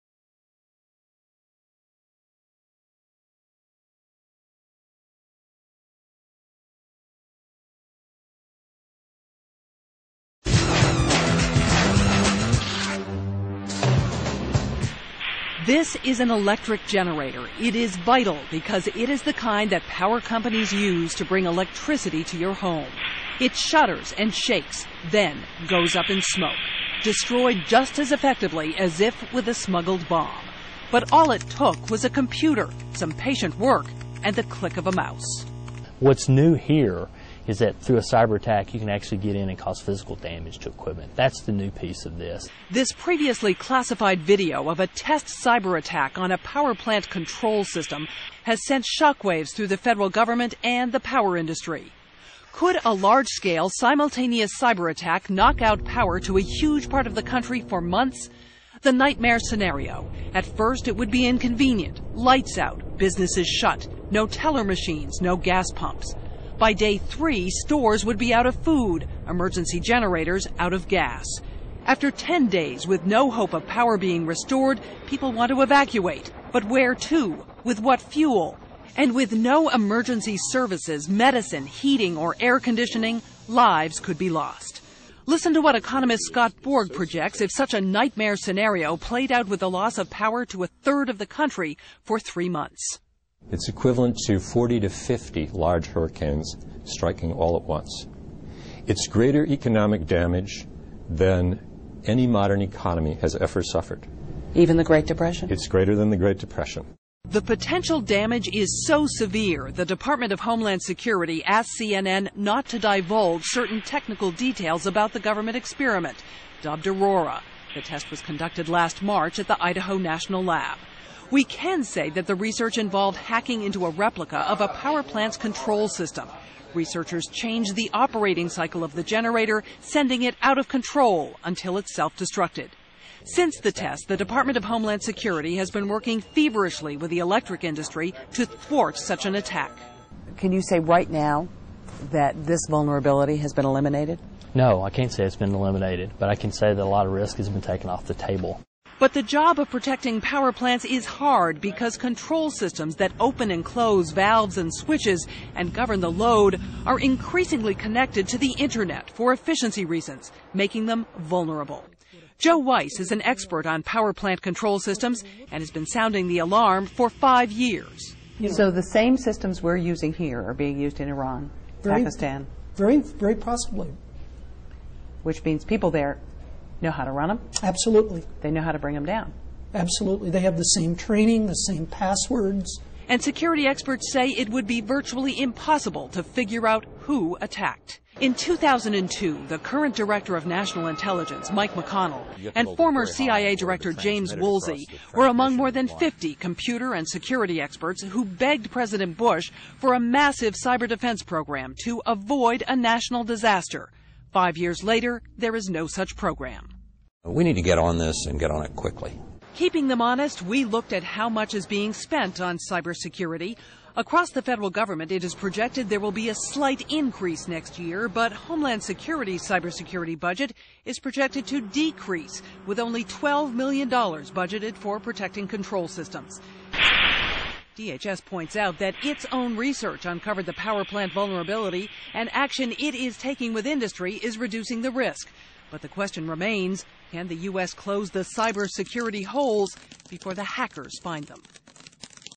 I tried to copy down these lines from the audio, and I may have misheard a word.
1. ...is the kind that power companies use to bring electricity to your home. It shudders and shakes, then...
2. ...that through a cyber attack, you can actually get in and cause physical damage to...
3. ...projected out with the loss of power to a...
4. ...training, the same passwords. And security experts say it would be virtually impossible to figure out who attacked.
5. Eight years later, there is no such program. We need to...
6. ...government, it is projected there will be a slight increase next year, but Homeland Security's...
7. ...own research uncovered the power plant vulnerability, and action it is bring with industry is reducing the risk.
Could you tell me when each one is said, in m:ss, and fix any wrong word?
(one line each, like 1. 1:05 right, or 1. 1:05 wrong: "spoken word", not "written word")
1. 0:19 right
2. 0:37 right
3. 1:28 wrong: "played", not "projected"
4. 3:00 right
5. 3:24 wrong: "Five", not "Eight"
6. 3:34 right
7. 3:49 wrong: "taking", not "bring".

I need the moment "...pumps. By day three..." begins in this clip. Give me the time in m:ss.
1:05.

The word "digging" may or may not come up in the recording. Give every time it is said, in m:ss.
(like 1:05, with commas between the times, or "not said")
not said.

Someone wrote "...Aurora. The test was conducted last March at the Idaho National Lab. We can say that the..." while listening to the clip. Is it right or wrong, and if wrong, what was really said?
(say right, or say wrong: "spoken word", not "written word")
right.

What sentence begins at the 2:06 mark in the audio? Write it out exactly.
Researchers changed the operating cycle of the generator, sending it out of control until it self destructed.